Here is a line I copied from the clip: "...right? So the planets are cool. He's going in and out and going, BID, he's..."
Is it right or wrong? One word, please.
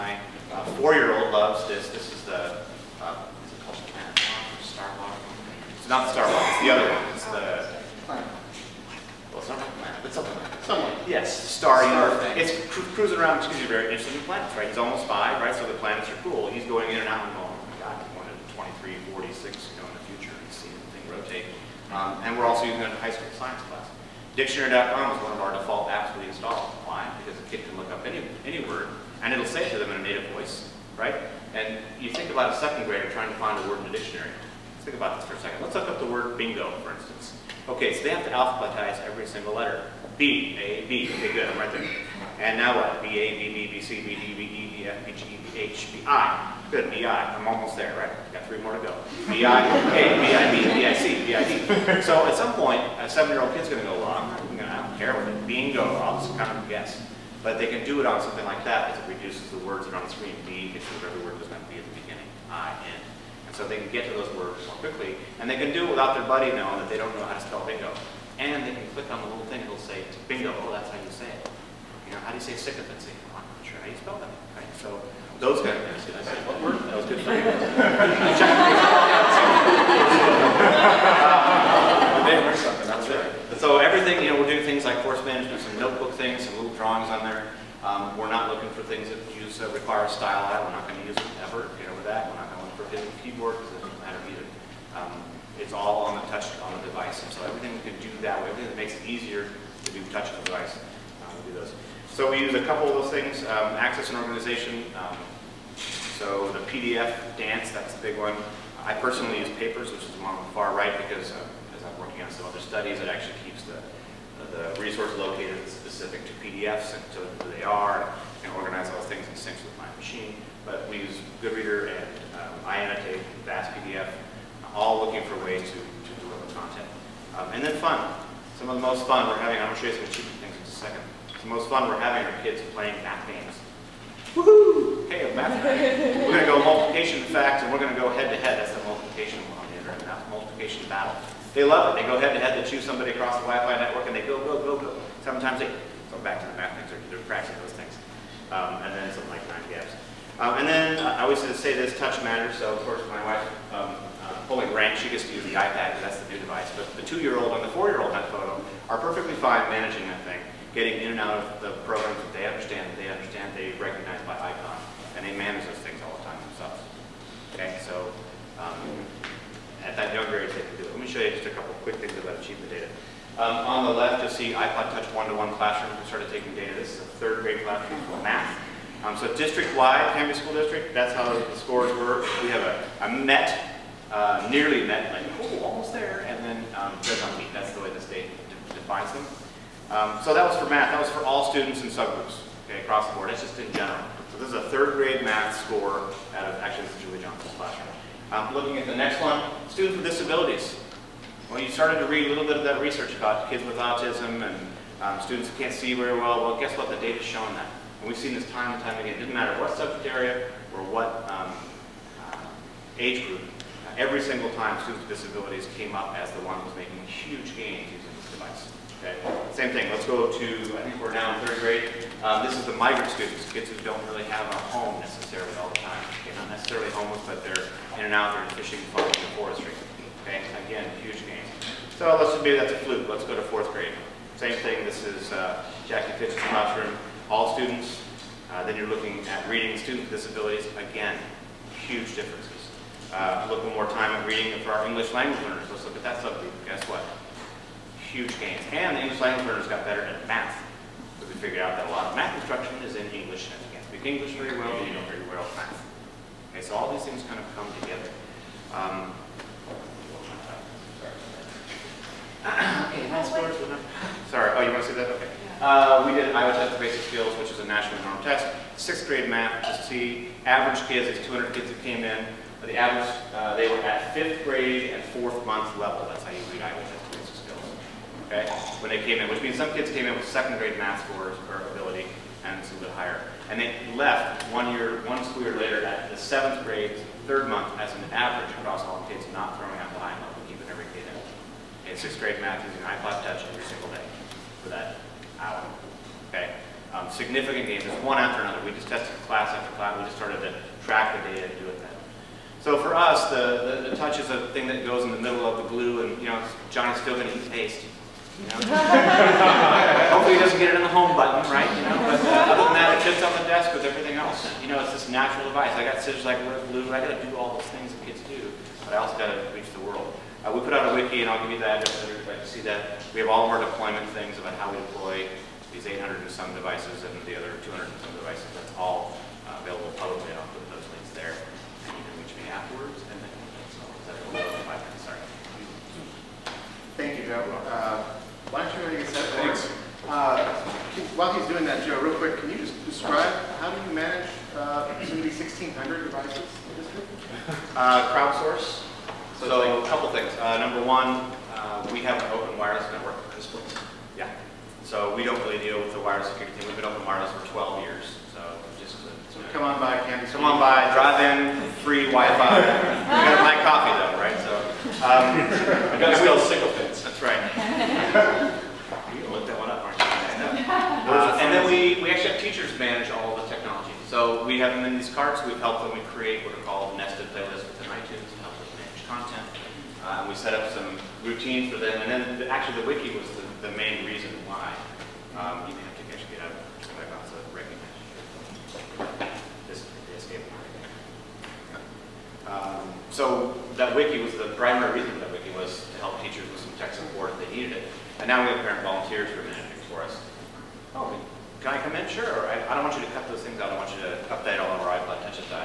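wrong.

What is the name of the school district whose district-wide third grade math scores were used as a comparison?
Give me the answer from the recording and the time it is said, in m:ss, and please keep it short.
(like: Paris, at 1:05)
Canby School District, at 3:00.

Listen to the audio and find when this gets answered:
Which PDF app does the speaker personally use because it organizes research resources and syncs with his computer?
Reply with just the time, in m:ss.
1:49.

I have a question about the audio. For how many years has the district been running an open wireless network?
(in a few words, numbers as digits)
12.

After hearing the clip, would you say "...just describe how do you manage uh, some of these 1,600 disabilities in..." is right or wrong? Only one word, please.
wrong.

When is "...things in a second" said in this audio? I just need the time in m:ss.
2:10.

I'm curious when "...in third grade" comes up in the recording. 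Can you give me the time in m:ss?
3:41.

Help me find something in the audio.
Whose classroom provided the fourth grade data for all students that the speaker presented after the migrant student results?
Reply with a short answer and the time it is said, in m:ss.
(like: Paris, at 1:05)
Jackie Fitch, at 3:55.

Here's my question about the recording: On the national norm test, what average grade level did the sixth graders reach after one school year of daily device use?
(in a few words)
seventh grade, third month.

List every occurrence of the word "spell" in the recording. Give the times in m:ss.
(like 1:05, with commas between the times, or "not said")
1:07, 1:13.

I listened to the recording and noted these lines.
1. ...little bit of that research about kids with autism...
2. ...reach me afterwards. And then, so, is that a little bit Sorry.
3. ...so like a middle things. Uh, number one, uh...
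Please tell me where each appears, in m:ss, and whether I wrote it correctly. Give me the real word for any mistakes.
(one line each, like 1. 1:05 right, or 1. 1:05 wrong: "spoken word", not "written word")
1. 3:22 right
2. 5:32 right
3. 5:49 wrong: "couple", not "middle".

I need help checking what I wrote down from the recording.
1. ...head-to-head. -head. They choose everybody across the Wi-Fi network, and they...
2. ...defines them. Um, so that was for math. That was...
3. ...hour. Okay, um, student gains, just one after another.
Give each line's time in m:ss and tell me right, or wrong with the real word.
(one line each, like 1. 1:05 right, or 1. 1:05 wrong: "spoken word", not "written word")
1. 2:22 wrong: "somebody", not "everybody"
2. 3:08 right
3. 4:55 wrong: "significant", not "student".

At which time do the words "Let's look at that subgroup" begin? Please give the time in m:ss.
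4:05.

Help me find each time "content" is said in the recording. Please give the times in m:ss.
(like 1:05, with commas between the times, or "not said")
2:06, 6:19.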